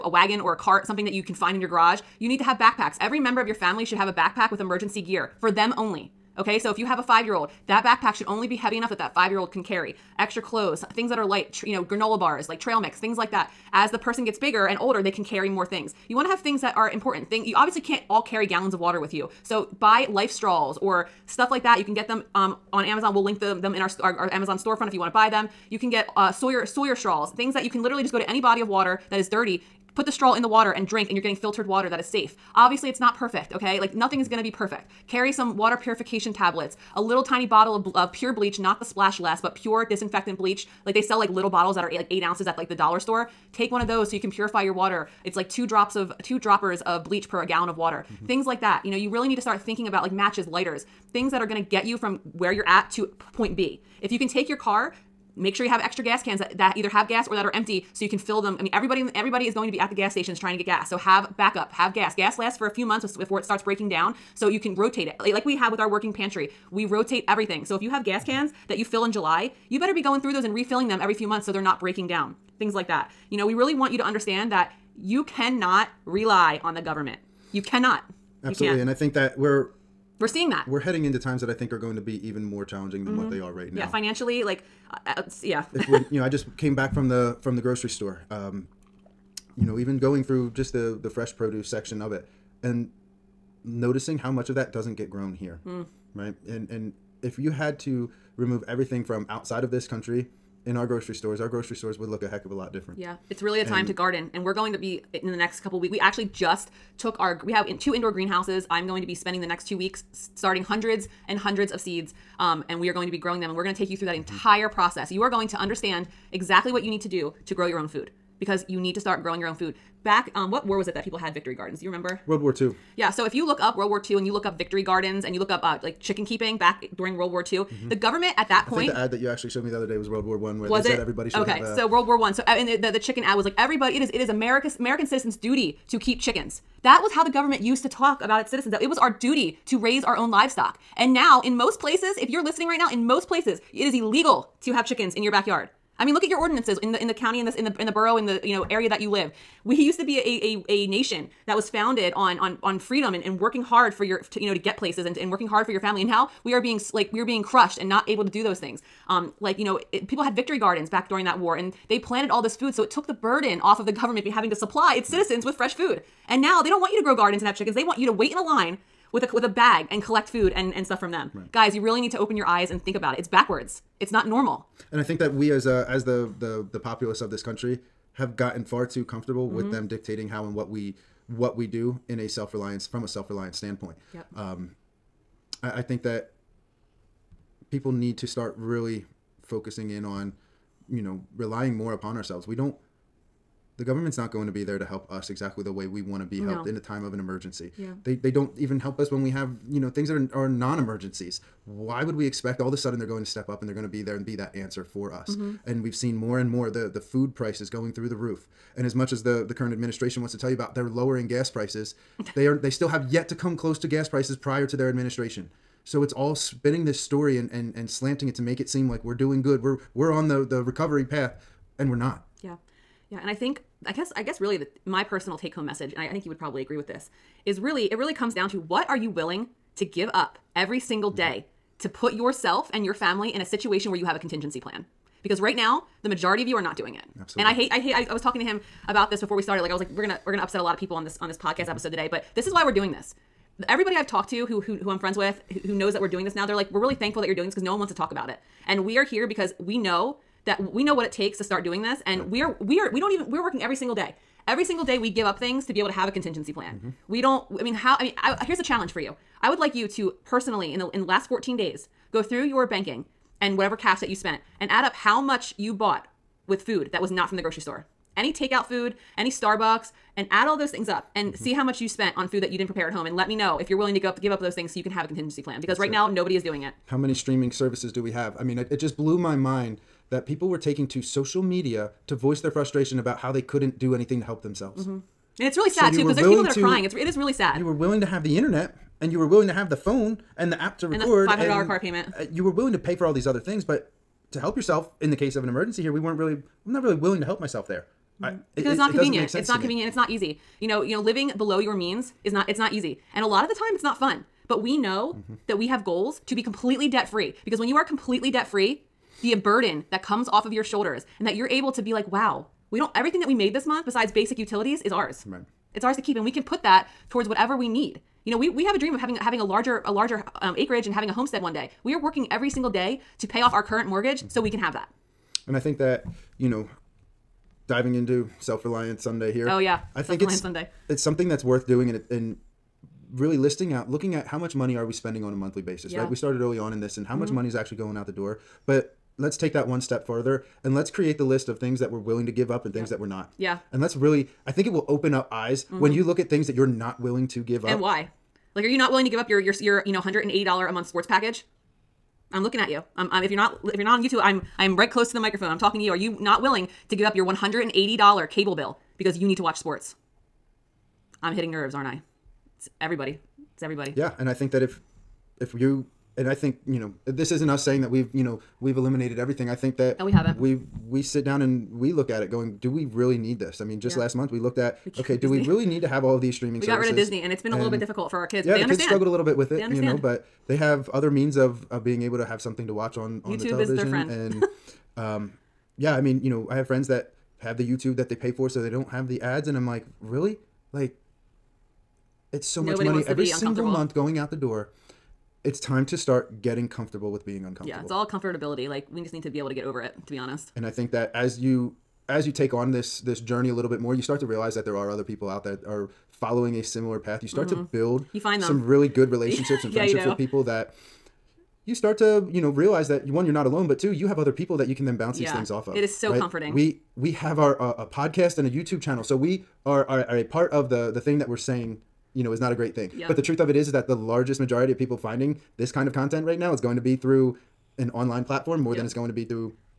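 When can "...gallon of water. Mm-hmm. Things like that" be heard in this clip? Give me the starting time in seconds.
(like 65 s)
47 s.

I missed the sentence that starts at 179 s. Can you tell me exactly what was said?
with them dictating how and what we what we do in a self-reliance from a self-reliance standpoint.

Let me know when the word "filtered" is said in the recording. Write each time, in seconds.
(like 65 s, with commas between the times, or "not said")
31 s.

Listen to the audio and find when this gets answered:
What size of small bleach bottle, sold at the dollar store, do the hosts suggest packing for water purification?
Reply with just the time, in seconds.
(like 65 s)
42 s.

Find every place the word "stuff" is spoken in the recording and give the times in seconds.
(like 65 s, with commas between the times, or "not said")
21 s, 170 s.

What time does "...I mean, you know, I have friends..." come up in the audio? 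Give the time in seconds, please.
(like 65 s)
385 s.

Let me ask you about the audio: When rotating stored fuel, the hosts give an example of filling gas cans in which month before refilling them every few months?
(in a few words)
July.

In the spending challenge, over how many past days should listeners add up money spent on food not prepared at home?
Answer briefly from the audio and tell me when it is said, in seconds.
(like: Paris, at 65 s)
14 days, at 261 s.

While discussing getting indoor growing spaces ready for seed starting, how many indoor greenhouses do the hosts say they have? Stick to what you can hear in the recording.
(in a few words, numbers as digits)
2.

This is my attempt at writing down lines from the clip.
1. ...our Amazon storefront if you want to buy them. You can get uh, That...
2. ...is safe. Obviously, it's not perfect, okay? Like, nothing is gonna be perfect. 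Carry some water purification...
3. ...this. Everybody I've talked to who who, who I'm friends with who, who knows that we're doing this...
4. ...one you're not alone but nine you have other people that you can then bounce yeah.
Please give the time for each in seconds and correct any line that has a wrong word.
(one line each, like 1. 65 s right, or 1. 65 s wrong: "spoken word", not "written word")
1. 24 s wrong: "Sawyer", not "That"
2. 31 s right
3. 242 s right
4. 413 s wrong: "two", not "nine".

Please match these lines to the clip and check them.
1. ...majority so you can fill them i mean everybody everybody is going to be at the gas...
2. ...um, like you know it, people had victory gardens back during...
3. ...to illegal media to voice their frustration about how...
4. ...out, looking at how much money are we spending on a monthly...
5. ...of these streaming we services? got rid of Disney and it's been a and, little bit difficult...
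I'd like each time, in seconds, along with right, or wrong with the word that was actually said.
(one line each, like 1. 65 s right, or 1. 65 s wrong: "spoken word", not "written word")
1. 57 s wrong: "empty", not "majority"
2. 159 s right
3. 280 s wrong: "social", not "illegal"
4. 333 s right
5. 376 s right.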